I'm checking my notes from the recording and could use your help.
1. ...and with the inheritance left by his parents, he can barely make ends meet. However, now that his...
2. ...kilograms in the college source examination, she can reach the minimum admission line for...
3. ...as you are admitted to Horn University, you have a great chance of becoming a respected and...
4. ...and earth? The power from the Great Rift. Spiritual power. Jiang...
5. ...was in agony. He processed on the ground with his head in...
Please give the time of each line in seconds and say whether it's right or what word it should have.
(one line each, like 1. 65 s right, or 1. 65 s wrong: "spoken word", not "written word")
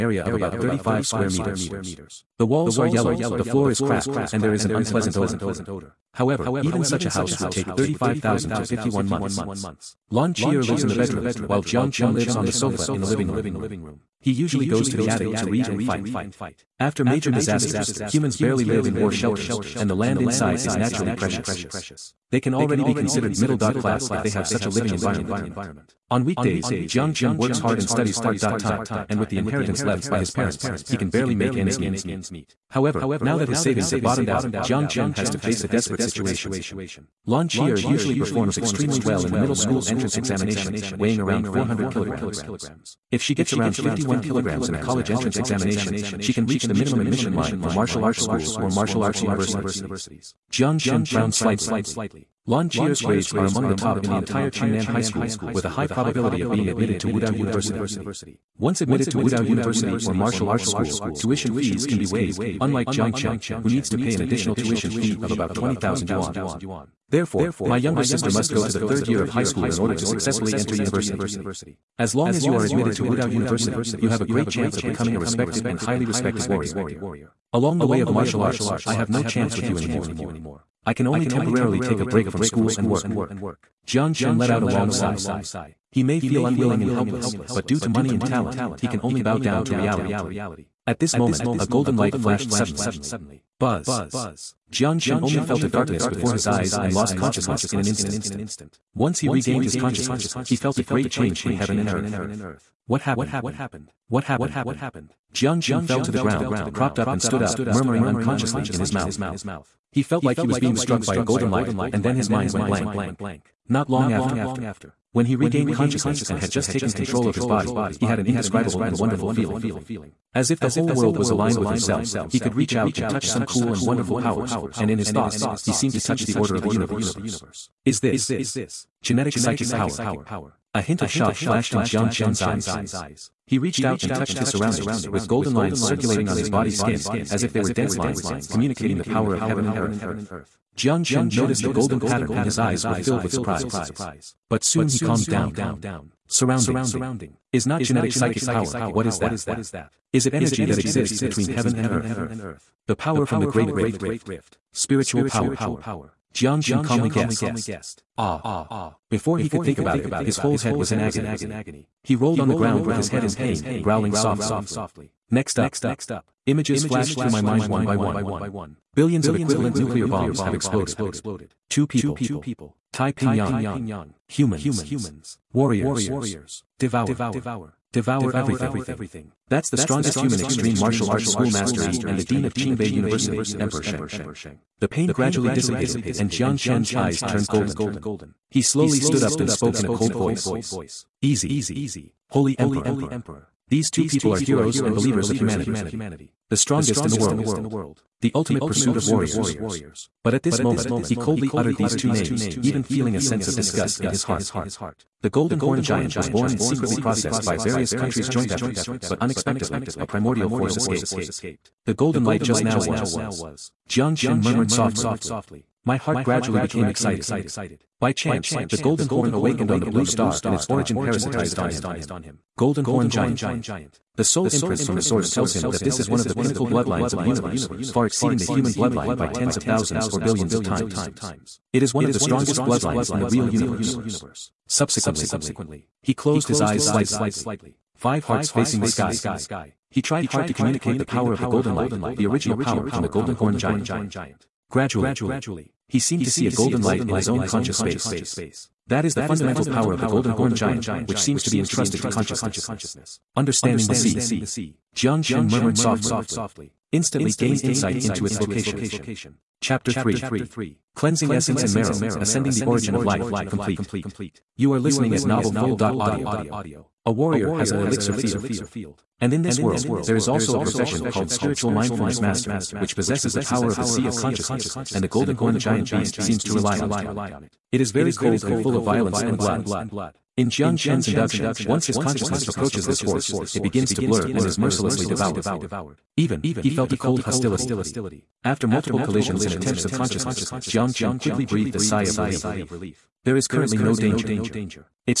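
1. 29 s right
2. 44 s wrong: "entrance", not "source"
3. 72 s wrong: "Wudao", not "Horn"
4. 151 s right
5. 160 s wrong: "rolled", not "processed".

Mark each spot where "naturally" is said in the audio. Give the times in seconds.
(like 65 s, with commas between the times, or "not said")
20 s.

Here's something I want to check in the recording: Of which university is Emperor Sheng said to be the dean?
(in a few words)
Qingbei University.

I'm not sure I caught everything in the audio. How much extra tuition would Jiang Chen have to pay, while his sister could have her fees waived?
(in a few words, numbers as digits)
20,000 yuan.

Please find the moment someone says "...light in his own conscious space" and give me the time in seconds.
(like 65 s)
246 s.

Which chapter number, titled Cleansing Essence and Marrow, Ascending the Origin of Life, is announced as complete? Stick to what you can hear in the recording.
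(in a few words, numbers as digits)
3.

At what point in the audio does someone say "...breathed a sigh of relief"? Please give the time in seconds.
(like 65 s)
291 s.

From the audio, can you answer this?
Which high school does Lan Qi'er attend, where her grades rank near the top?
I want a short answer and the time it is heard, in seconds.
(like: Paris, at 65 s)
Qingnan High School, at 54 s.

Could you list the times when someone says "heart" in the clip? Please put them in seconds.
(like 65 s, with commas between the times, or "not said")
204 s, 215 s, 238 s.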